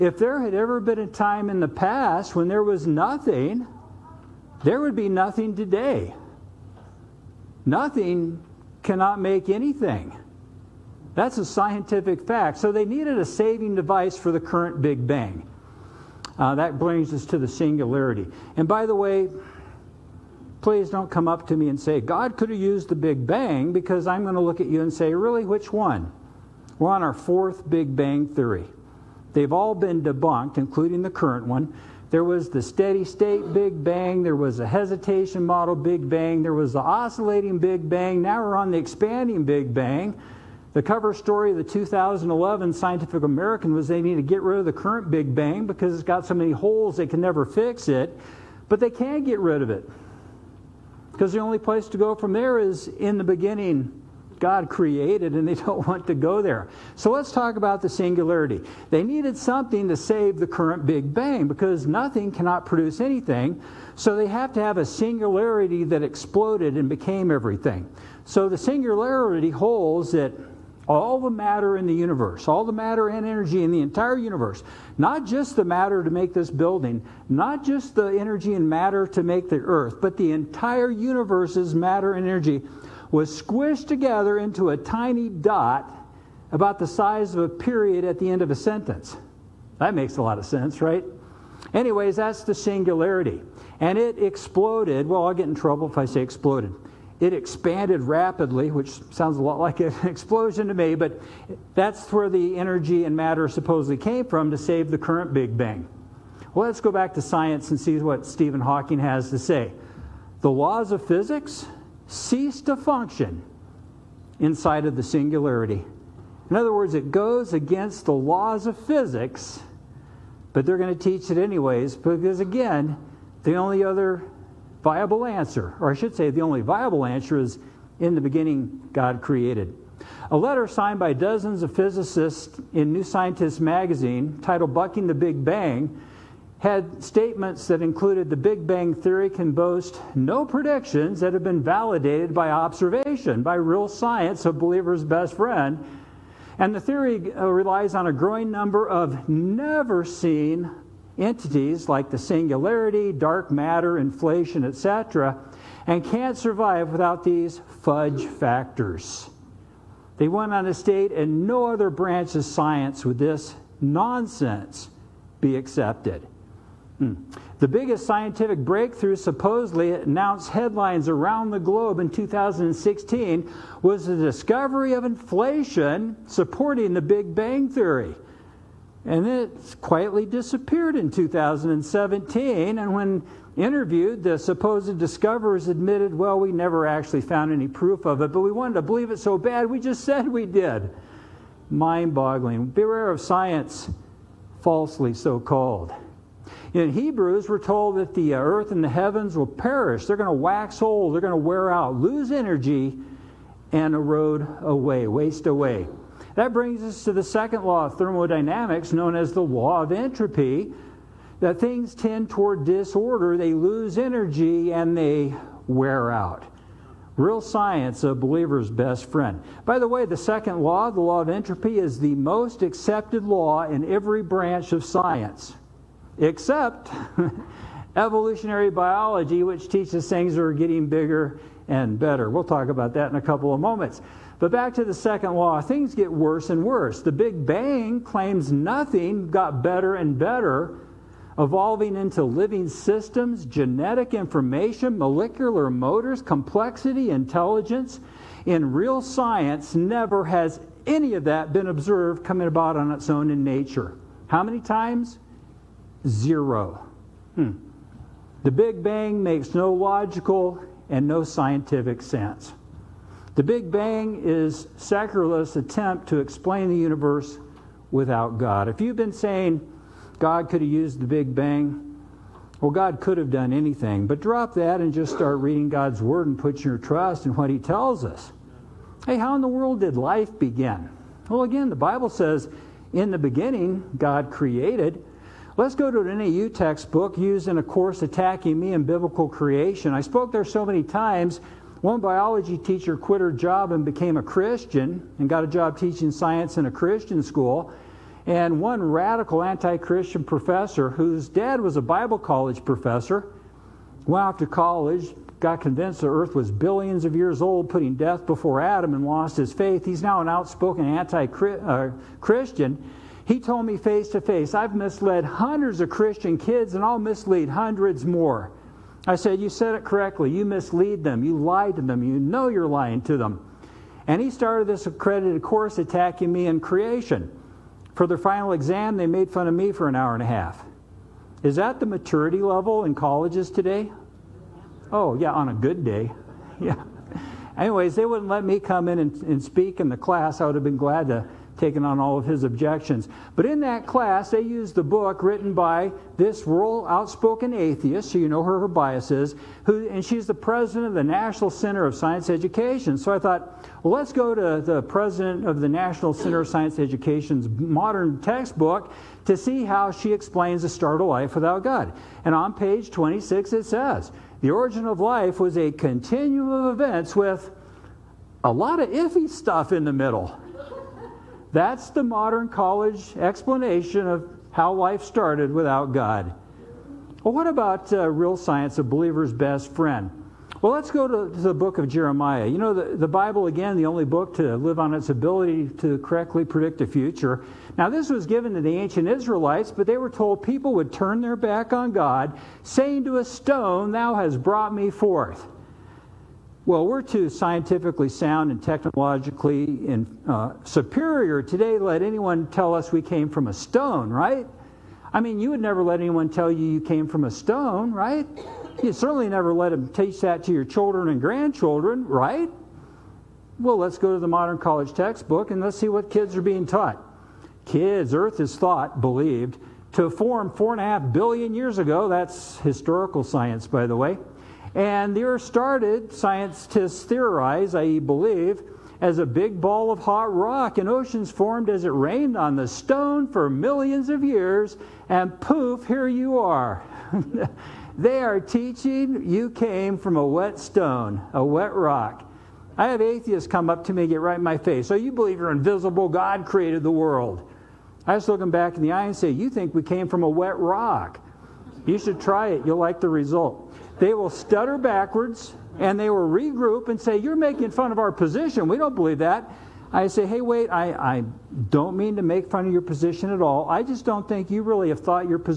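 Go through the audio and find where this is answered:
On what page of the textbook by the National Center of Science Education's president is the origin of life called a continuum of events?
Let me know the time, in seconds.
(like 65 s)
362 s.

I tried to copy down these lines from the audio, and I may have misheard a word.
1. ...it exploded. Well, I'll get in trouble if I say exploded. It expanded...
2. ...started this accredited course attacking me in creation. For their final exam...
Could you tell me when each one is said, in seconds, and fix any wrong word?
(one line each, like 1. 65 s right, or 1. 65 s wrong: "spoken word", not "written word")
1. 93 s right
2. 324 s right.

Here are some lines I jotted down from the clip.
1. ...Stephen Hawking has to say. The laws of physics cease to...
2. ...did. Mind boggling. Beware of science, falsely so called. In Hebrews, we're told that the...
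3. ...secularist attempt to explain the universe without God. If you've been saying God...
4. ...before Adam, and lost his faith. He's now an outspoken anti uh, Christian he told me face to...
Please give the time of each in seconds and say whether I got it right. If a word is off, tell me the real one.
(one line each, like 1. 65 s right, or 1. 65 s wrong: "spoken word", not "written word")
1. 108 s right
2. 190 s right
3. 264 s right
4. 308 s right.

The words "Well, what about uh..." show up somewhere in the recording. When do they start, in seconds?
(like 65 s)
377 s.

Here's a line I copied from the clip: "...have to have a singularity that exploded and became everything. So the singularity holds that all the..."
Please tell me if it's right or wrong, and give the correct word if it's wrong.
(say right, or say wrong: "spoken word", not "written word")
right.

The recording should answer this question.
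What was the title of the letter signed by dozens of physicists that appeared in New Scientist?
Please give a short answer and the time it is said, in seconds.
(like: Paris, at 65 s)
Bucking the Big Bang, at 134 s.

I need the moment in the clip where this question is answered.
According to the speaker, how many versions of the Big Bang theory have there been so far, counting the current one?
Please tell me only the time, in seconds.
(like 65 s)
27 s.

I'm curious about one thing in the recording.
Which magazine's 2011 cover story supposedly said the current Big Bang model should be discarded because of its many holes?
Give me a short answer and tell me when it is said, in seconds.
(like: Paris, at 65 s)
Scientific American, at 42 s.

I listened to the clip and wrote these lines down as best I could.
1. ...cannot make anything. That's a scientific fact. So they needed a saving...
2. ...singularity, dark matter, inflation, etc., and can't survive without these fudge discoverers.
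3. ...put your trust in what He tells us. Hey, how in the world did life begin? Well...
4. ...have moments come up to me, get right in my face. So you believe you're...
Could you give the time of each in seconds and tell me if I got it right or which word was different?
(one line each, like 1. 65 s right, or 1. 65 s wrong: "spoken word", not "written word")
1. 8 s right
2. 152 s wrong: "factors", not "discoverers"
3. 276 s right
4. 442 s wrong: "atheists", not "moments".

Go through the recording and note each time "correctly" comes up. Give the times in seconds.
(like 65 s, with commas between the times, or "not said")
319 s, 385 s.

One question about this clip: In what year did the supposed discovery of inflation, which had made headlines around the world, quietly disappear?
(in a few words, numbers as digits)
2017.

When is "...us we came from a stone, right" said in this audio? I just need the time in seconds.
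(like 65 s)
402 s.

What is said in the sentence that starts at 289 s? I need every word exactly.
I spoke there so many times.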